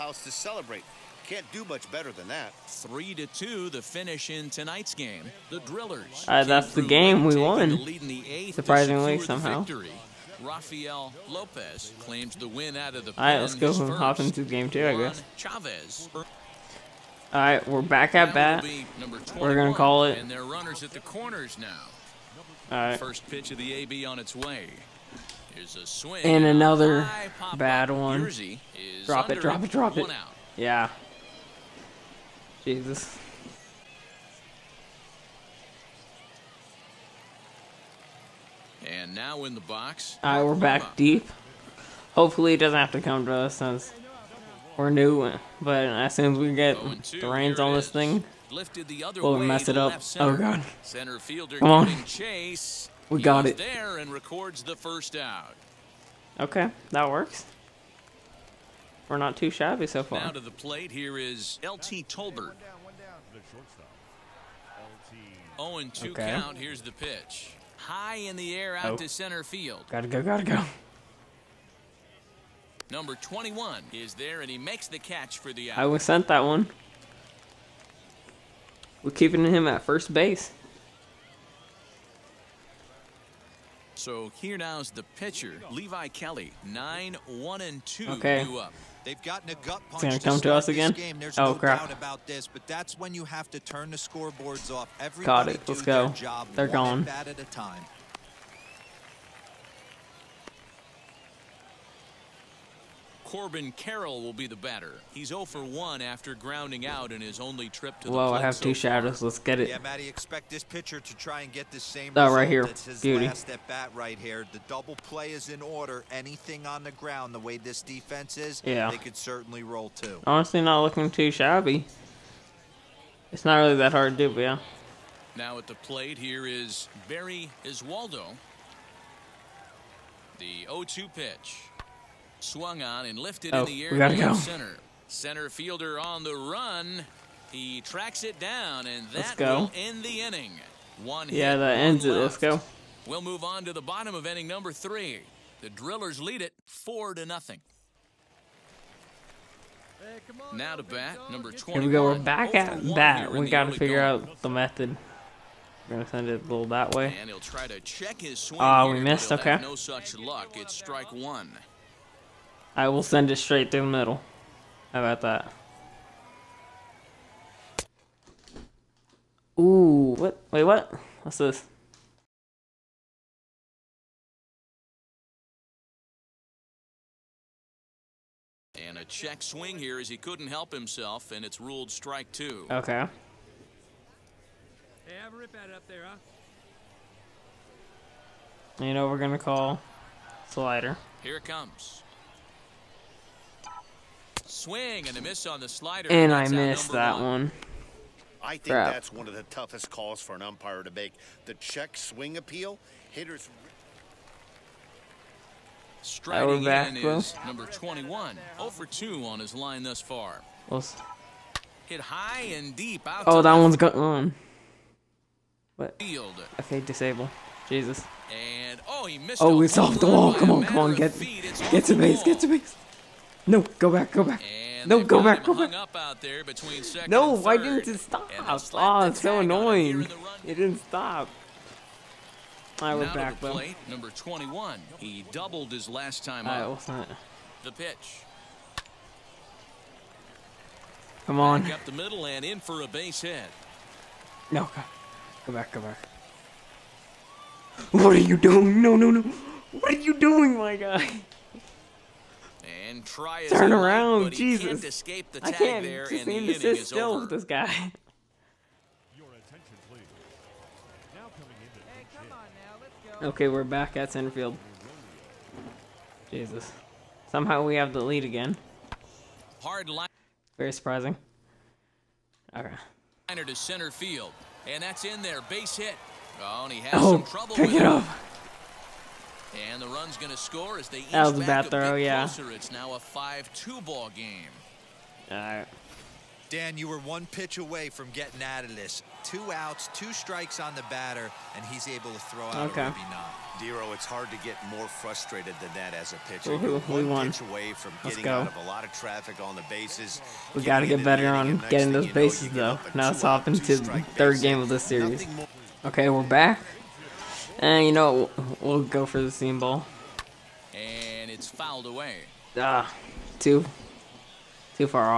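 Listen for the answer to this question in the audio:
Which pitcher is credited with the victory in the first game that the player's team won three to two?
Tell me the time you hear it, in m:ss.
0:10.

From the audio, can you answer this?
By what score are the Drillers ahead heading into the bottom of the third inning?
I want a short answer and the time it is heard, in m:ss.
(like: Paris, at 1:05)
4 to 0, at 2:26.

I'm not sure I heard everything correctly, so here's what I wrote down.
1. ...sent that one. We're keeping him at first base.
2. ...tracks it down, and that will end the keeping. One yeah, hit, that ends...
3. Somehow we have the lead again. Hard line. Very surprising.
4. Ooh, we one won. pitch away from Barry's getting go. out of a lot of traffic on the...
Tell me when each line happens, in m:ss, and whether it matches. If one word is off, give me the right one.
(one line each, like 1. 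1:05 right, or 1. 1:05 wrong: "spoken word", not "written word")
1. 1:16 right
2. 2:17 wrong: "inning", not "keeping"
3. 4:27 right
4. 4:56 wrong: "Let", not "Barry".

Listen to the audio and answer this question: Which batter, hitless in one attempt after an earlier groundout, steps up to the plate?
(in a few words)
Corbin Carroll.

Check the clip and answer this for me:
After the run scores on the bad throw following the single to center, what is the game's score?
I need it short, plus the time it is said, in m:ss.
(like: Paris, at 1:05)
5-2, at 4:42.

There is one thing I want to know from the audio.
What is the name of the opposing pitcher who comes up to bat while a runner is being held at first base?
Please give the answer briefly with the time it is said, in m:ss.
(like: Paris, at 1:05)
Levi Kelly, at 1:25.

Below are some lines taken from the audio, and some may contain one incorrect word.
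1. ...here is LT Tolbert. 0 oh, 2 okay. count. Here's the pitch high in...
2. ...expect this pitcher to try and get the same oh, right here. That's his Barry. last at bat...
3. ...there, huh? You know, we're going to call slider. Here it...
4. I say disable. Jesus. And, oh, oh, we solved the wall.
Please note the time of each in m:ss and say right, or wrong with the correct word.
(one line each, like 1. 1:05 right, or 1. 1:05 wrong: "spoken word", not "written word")
1. 1:00 right
2. 1:50 wrong: "Beauty", not "Barry"
3. 3:05 right
4. 3:36 right.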